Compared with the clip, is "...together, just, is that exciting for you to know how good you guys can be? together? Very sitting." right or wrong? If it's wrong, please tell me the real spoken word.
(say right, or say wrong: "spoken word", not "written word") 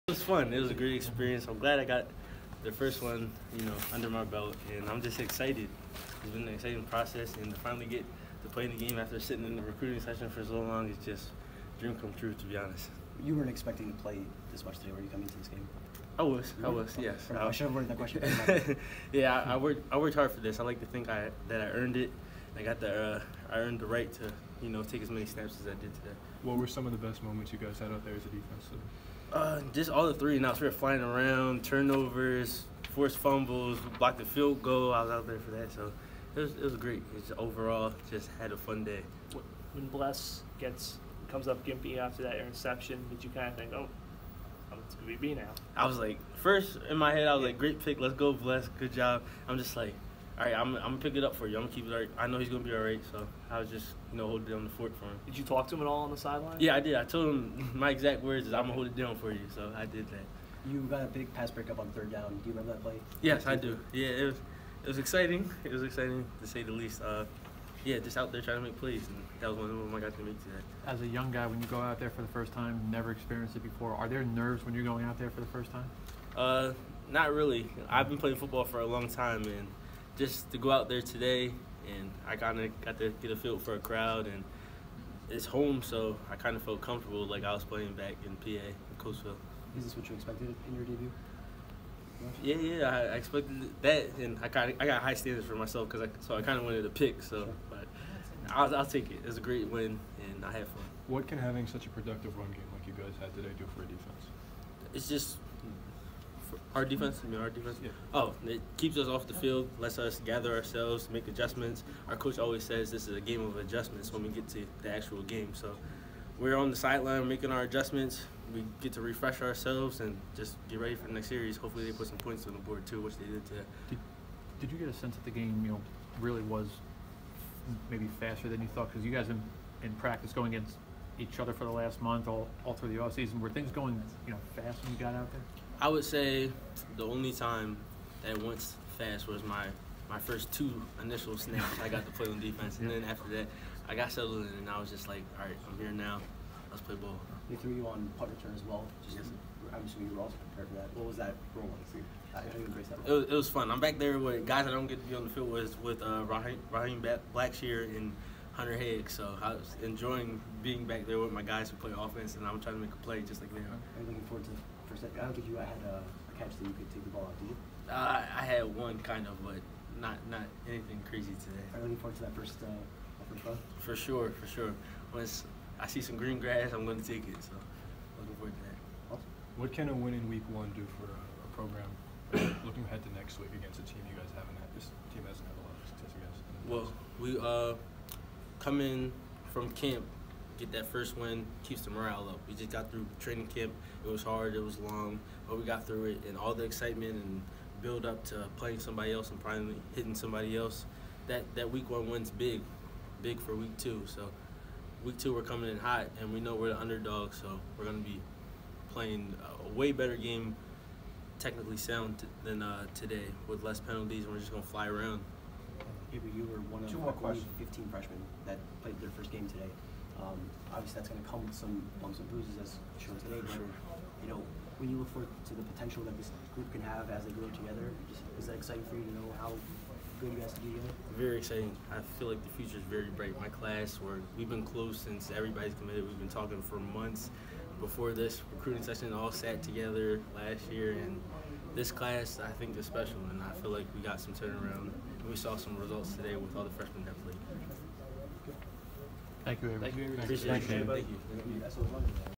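wrong: "exciting", not "sitting".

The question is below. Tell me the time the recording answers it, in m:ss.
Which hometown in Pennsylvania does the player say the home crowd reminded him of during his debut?
1:28.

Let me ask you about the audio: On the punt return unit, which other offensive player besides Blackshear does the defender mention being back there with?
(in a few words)
Hunter Higgs.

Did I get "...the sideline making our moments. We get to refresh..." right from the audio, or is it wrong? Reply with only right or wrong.
wrong.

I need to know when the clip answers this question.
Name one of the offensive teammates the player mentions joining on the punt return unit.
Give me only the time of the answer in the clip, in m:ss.
2:36.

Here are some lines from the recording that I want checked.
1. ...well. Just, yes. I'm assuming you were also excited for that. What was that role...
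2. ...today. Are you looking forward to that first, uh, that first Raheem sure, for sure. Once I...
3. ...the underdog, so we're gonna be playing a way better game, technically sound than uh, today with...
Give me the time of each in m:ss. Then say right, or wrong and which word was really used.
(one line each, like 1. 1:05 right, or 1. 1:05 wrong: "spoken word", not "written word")
1. 2:28 wrong: "prepared", not "excited"
2. 2:51 wrong: "For", not "Raheem"
3. 3:26 right.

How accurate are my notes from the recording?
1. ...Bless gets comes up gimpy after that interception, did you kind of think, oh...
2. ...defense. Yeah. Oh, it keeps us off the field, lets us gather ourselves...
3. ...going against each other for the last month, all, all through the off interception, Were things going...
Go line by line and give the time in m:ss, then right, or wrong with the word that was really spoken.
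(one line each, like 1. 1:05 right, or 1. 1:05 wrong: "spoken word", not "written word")
1. 0:39 right
2. 1:47 right
3. 2:10 wrong: "season", not "interception".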